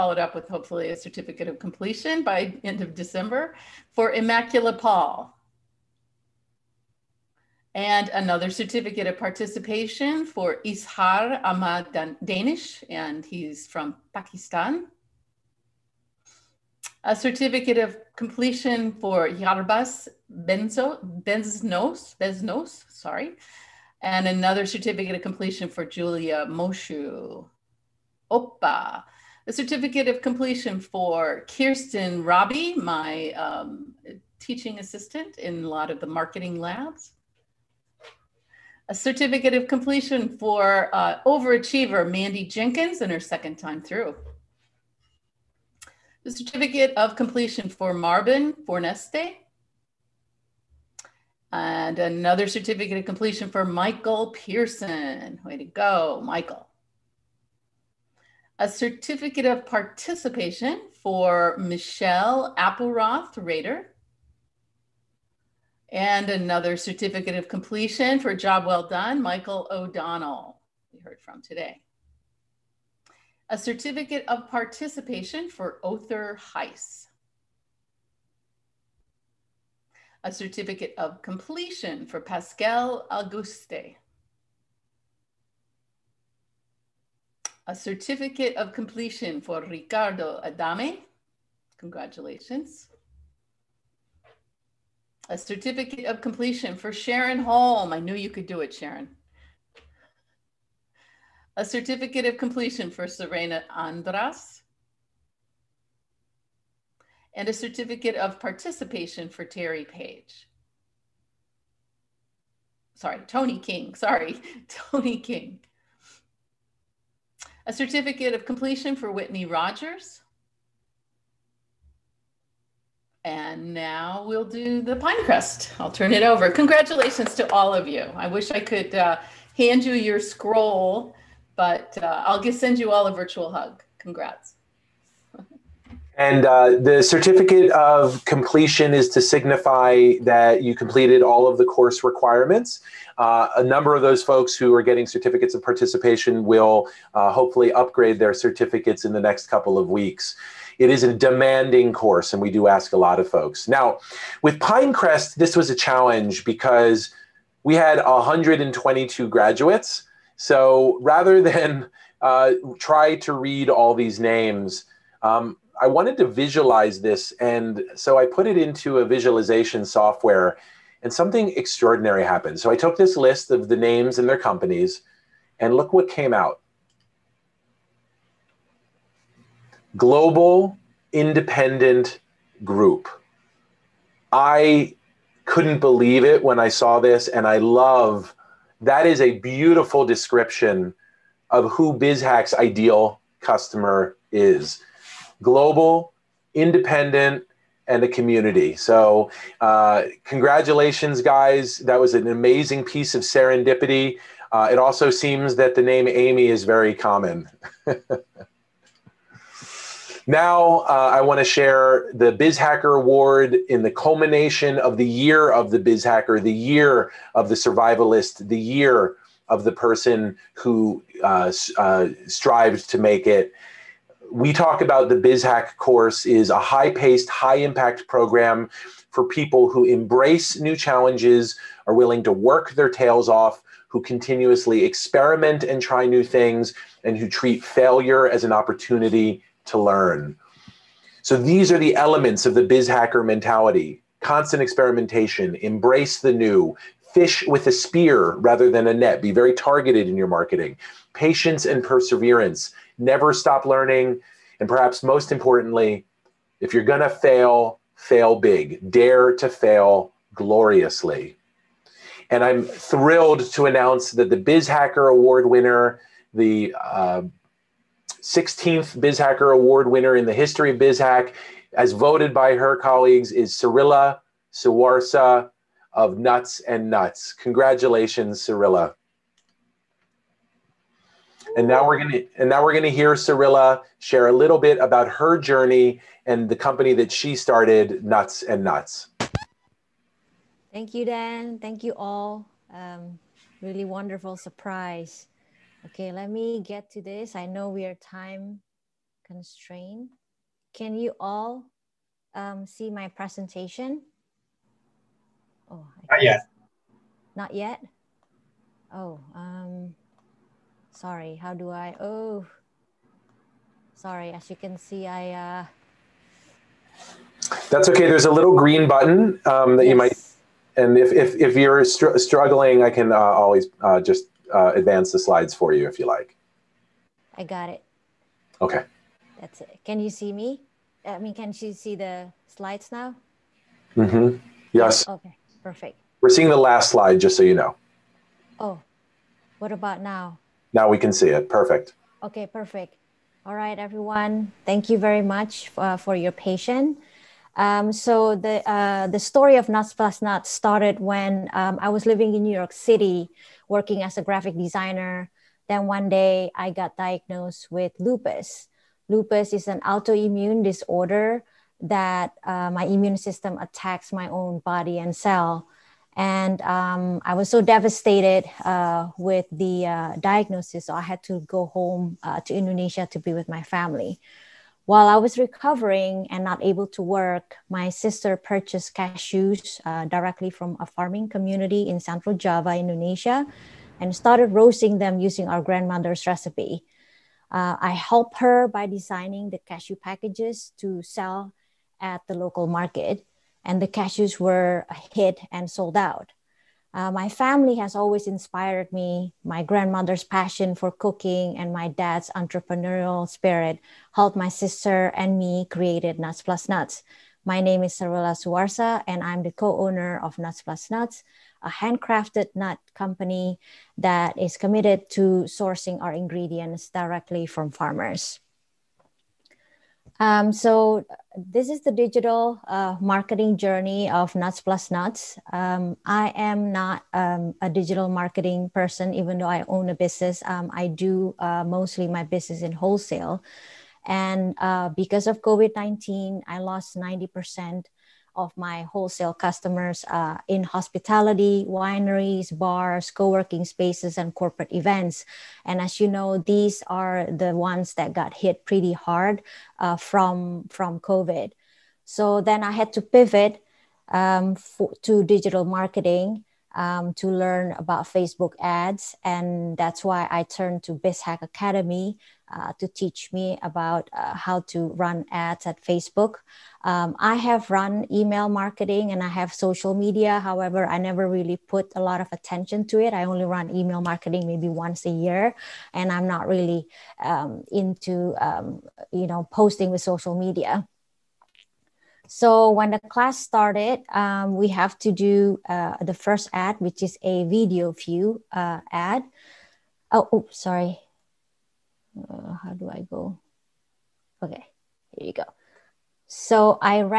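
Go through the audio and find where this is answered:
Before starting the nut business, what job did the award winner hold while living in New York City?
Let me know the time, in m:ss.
5:54.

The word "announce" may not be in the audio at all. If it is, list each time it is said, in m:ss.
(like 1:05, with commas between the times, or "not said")
4:23.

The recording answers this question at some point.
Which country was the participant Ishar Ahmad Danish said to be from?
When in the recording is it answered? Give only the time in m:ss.
0:14.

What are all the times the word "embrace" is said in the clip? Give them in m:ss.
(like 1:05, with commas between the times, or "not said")
3:49, 4:05.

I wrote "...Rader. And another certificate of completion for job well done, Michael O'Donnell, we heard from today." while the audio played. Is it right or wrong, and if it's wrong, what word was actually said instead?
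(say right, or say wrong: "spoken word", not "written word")
right.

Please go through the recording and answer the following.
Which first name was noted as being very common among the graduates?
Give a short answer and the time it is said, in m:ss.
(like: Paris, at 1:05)
Amy, at 3:26.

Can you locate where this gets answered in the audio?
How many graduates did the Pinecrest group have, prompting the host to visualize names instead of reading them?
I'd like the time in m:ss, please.
2:38.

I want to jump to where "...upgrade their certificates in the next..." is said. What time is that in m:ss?
2:27.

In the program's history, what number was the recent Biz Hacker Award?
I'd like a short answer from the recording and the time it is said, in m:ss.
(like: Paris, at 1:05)
16th, at 4:28.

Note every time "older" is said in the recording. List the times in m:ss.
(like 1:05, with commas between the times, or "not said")
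not said.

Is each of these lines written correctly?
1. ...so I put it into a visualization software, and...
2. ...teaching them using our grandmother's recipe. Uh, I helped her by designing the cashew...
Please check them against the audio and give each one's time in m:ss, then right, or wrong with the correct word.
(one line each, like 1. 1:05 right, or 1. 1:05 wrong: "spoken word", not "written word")
1. 2:47 right
2. 6:24 wrong: "roasting", not "teaching".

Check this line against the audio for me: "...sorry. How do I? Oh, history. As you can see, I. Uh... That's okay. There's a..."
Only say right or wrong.
wrong.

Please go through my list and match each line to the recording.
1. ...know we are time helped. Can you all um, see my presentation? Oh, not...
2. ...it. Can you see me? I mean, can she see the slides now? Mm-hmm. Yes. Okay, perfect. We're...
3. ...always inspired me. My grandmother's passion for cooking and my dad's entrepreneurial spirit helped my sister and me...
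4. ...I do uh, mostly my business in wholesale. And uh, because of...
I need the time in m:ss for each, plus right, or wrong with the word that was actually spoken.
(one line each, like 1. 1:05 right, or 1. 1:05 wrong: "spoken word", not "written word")
1. 4:57 wrong: "constrained", not "helped"
2. 5:29 right
3. 6:37 right
4. 7:10 right.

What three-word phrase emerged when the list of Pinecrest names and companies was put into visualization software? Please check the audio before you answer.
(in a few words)
global independent group.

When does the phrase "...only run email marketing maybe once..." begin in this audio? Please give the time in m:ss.
7:53.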